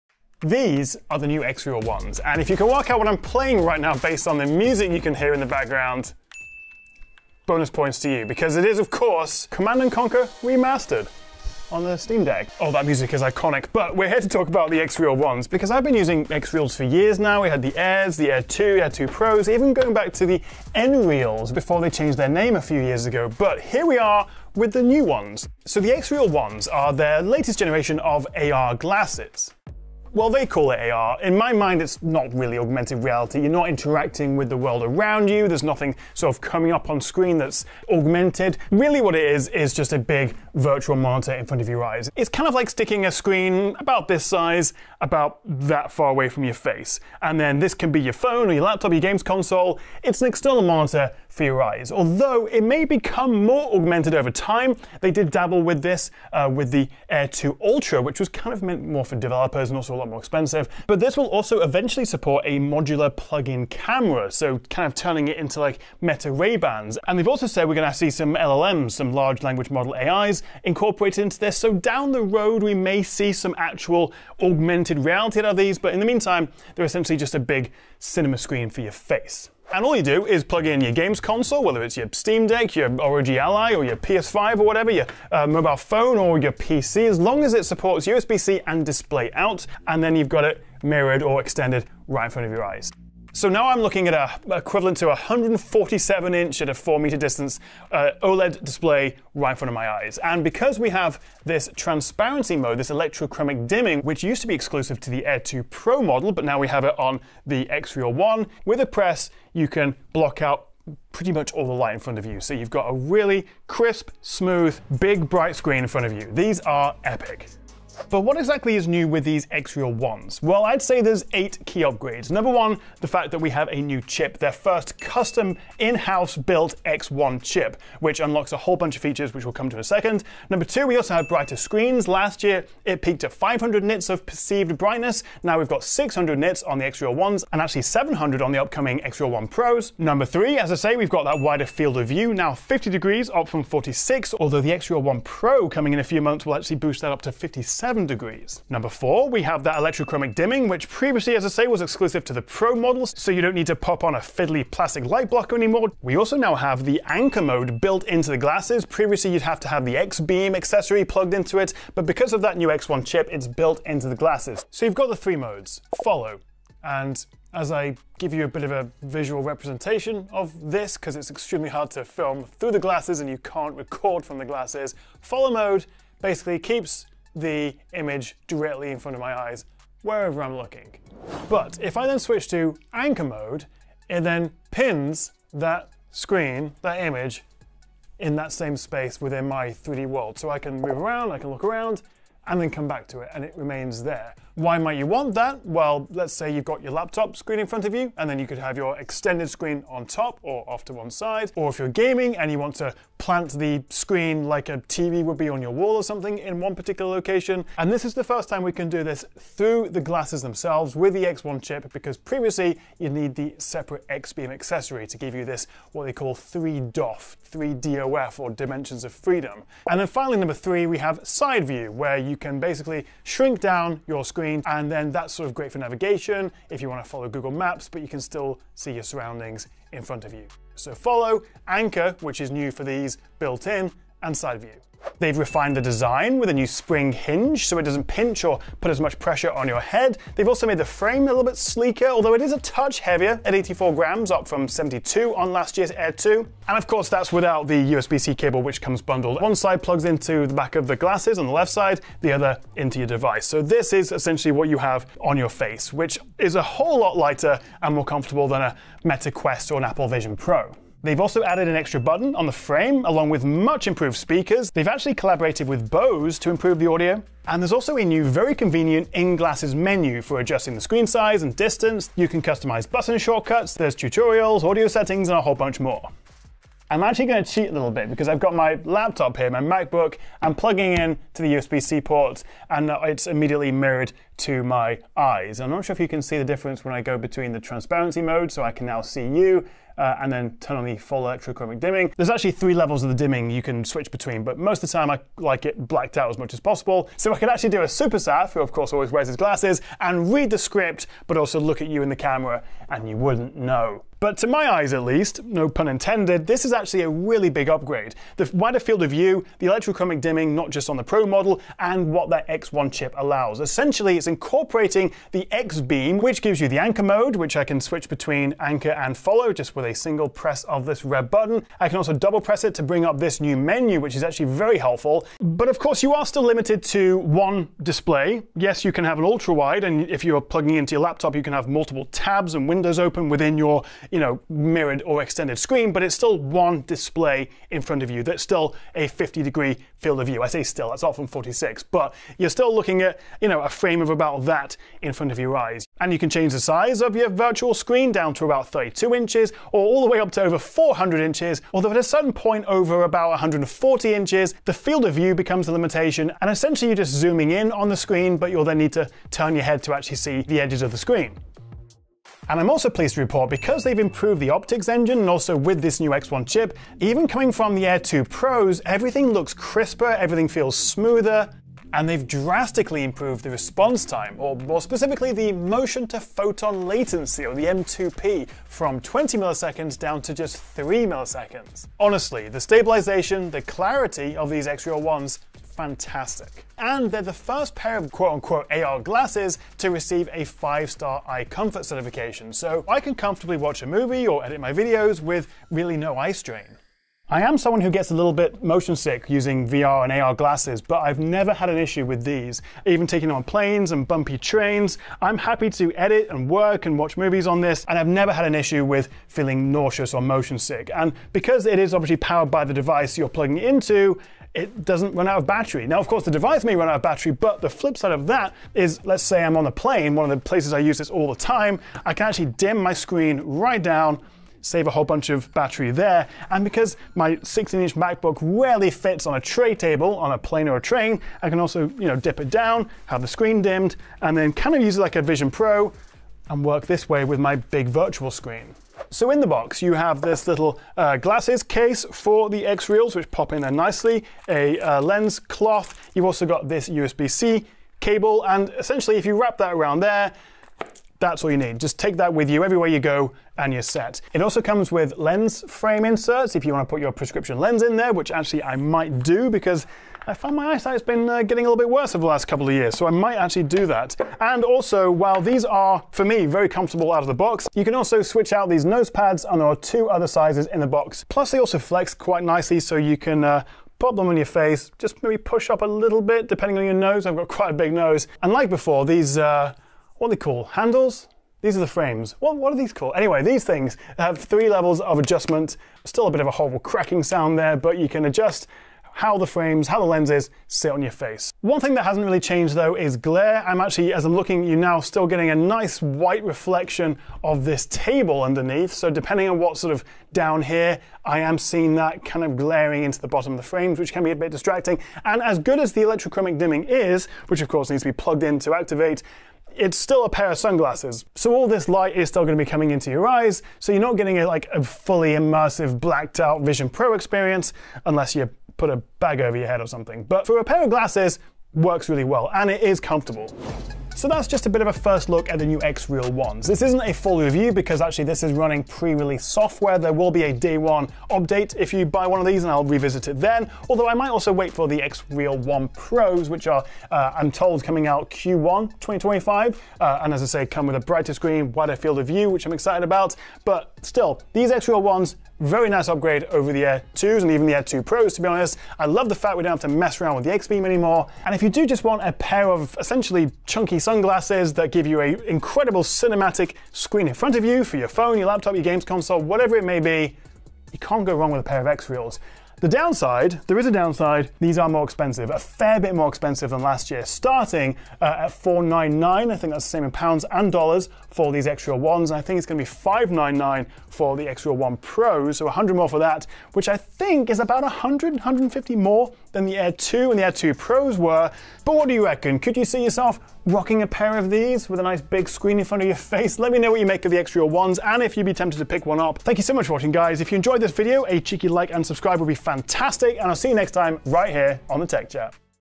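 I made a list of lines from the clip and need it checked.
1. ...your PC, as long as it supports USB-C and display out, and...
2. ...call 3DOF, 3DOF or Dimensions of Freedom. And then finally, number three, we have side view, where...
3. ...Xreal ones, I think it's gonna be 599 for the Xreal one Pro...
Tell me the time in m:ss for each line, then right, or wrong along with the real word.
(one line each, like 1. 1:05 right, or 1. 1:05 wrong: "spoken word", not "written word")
1. 1:26 right
2. 3:36 right
3. 9:31 right.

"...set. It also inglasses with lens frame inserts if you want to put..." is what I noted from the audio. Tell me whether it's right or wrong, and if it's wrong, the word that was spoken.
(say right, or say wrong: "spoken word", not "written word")
wrong: "comes", not "inglasses".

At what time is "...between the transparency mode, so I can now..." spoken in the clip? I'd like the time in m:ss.
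4:47.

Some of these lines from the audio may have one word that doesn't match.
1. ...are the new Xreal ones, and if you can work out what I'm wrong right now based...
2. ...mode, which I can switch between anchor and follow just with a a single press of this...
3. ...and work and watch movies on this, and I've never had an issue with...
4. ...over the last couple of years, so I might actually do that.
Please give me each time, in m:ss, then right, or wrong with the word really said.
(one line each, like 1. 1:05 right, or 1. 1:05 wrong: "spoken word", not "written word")
1. 0:01 wrong: "playing", not "wrong"
2. 5:17 right
3. 6:46 right
4. 7:42 right.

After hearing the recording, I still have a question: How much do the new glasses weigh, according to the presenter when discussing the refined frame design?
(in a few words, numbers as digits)
84 grams.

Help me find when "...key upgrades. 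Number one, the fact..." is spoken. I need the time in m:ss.
2:01.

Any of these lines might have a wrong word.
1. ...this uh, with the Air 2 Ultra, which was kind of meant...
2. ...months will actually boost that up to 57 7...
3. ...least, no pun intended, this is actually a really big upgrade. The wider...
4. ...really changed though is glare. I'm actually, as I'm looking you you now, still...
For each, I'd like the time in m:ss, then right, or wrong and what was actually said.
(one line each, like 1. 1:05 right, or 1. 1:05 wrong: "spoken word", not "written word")
1. 0:55 right
2. 2:26 right
3. 5:05 right
4. 8:12 right.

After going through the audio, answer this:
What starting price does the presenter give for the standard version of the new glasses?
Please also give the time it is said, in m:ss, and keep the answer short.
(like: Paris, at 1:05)
499, at 9:28.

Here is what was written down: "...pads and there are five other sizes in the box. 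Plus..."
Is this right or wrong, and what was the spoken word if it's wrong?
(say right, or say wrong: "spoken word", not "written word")
wrong: "two", not "five".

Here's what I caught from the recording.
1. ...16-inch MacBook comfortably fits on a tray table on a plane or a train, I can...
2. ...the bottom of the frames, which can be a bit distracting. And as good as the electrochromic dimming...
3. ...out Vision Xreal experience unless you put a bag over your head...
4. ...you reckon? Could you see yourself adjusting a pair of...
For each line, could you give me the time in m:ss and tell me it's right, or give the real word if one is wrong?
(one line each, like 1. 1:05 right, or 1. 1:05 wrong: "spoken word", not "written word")
1. 7:07 wrong: "rarely", not "comfortably"
2. 8:23 right
3. 8:36 wrong: "Pro", not "Xreal"
4. 9:42 wrong: "rocking", not "adjusting".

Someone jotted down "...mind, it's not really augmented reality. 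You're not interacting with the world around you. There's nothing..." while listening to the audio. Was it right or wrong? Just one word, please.
right.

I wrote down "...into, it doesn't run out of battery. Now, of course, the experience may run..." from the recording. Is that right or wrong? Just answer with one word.
wrong.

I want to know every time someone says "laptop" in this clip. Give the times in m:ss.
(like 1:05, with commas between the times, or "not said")
0:48, 3:16, 4:38, 5:31, 9:18.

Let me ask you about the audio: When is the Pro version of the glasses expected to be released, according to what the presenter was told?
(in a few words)
Q1 2025.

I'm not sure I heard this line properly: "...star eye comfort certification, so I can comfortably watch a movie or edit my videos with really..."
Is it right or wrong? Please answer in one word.
right.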